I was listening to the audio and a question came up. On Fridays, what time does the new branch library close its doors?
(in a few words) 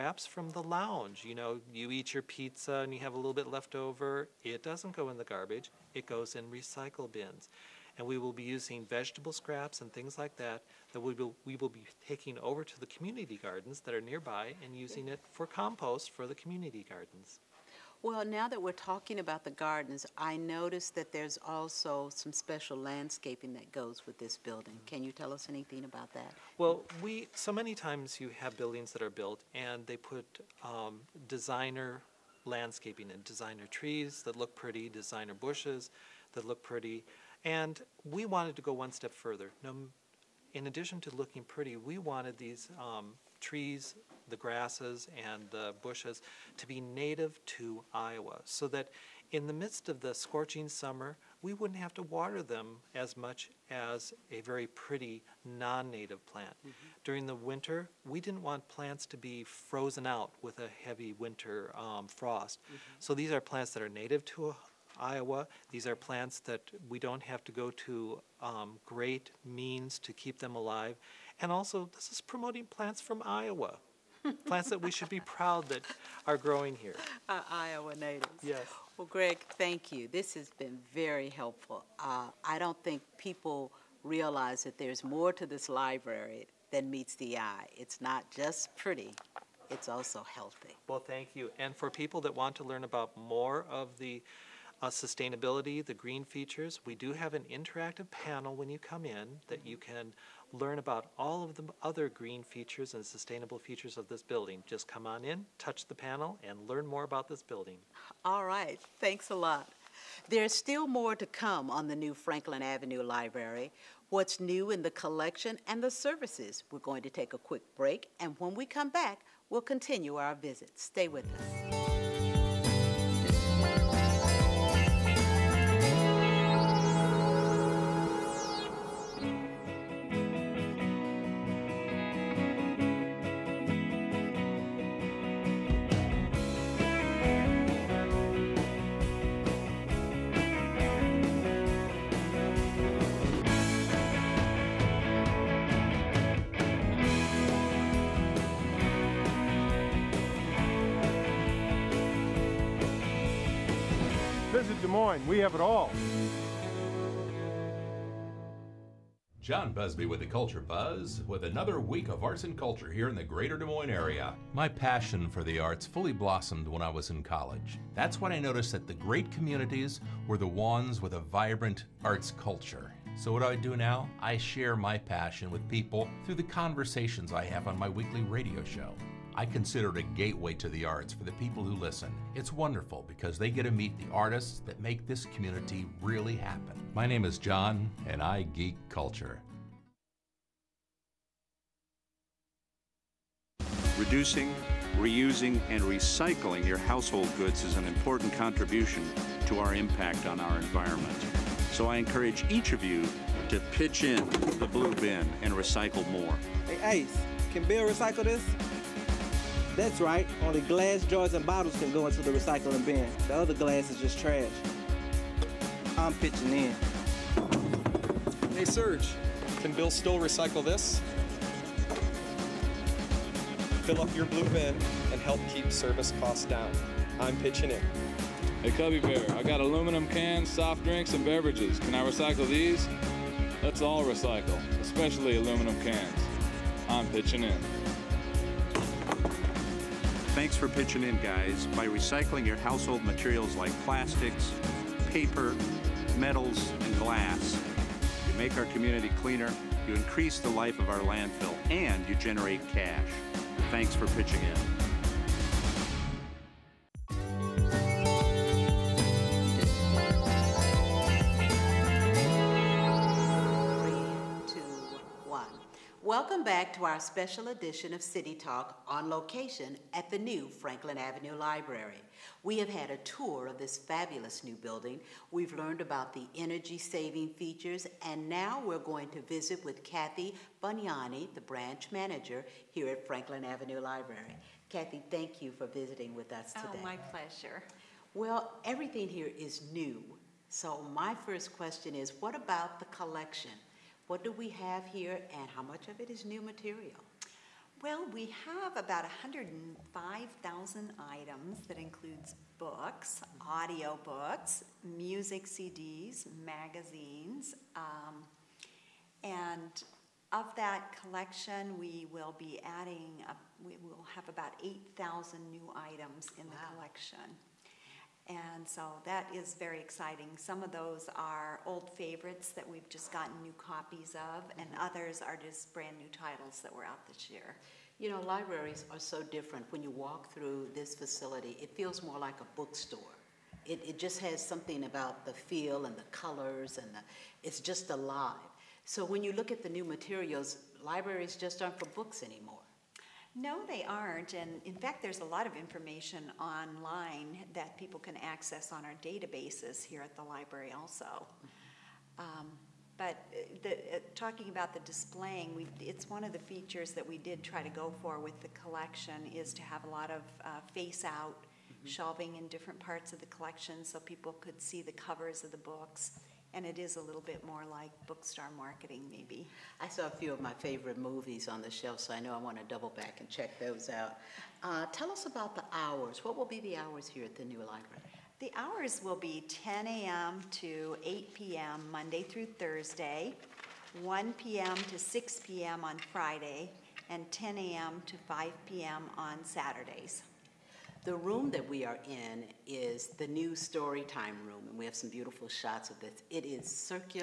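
6 p.m.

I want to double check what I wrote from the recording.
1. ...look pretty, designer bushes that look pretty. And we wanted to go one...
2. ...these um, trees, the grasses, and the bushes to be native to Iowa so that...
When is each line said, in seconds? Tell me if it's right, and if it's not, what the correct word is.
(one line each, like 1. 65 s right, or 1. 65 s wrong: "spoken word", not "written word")
1. 34 s right
2. 42 s right.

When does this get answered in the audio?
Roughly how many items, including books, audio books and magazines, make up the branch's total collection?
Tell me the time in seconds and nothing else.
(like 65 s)
299 s.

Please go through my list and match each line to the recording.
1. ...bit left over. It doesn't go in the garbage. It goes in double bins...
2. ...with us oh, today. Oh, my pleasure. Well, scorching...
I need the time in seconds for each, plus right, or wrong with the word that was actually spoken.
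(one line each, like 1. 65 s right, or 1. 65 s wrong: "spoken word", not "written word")
1. 3 s wrong: "recycle", not "double"
2. 286 s wrong: "everything", not "scorching".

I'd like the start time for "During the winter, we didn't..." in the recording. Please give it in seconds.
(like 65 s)
57 s.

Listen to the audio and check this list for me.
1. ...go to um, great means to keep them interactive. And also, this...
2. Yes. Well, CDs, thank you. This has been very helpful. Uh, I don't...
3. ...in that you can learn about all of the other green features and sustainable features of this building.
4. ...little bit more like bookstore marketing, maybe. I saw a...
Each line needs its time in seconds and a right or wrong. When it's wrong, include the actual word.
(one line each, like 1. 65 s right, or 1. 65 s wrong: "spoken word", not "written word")
1. 67 s wrong: "alive", not "interactive"
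2. 78 s wrong: "Greg", not "CDs"
3. 99 s right
4. 366 s right.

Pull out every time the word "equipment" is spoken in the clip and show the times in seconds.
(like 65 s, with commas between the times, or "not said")
not said.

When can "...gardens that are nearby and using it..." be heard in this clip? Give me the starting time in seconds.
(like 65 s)
13 s.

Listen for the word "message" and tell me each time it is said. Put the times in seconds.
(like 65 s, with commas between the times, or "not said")
not said.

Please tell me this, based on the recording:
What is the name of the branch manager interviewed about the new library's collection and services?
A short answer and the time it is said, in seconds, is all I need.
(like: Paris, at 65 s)
Kathy Bunyani, at 279 s.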